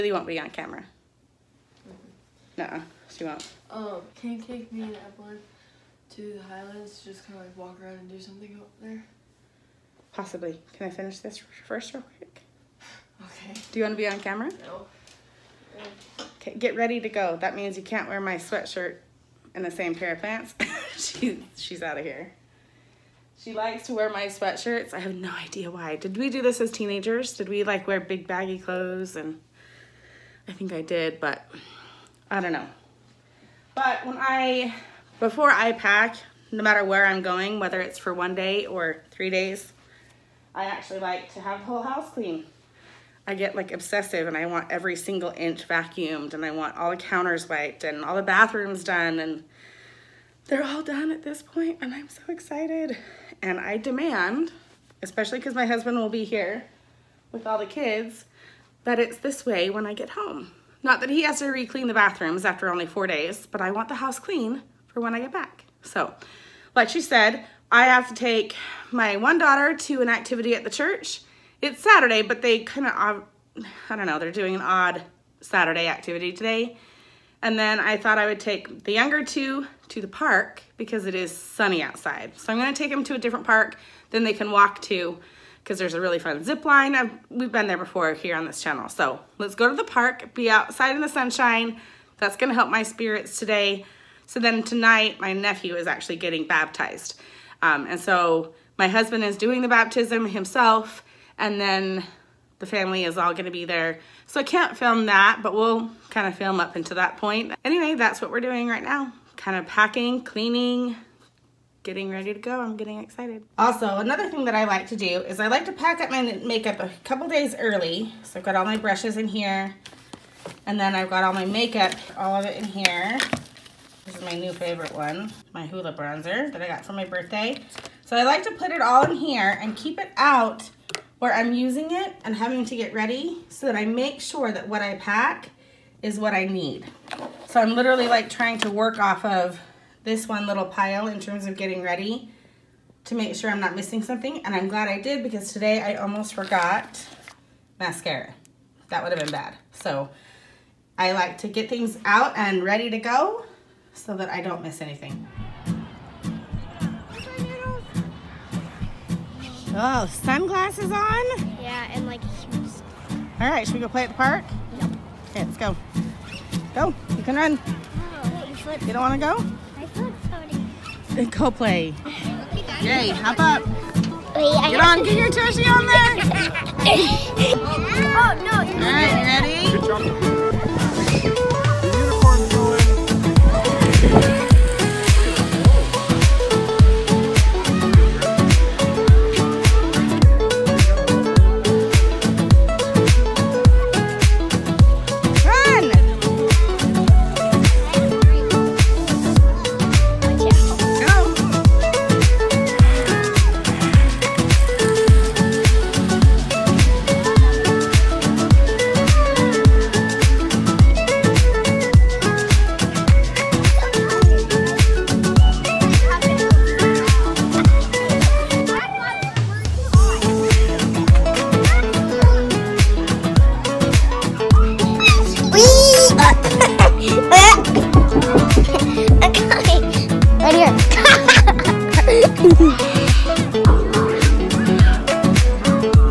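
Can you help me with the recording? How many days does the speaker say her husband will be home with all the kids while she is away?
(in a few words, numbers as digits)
4.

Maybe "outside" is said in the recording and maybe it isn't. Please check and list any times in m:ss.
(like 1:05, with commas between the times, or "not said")
1:21, 1:30.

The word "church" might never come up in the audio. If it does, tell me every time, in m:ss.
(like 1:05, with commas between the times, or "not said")
1:10.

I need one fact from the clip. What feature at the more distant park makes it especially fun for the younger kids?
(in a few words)
zip line.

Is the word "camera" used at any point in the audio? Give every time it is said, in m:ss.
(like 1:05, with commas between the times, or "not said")
0:00, 0:14.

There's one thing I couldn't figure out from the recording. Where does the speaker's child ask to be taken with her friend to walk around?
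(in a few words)
the Highlands.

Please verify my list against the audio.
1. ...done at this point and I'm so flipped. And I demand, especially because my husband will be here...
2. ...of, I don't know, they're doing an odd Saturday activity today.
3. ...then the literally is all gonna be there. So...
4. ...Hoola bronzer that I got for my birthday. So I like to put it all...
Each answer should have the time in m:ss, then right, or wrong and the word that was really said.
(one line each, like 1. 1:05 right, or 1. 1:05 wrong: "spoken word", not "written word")
1. 0:50 wrong: "excited", not "flipped"
2. 1:12 right
3. 1:41 wrong: "family", not "literally"
4. 2:05 right.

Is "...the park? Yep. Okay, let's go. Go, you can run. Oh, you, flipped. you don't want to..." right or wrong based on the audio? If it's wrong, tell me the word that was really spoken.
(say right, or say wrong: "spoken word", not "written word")
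right.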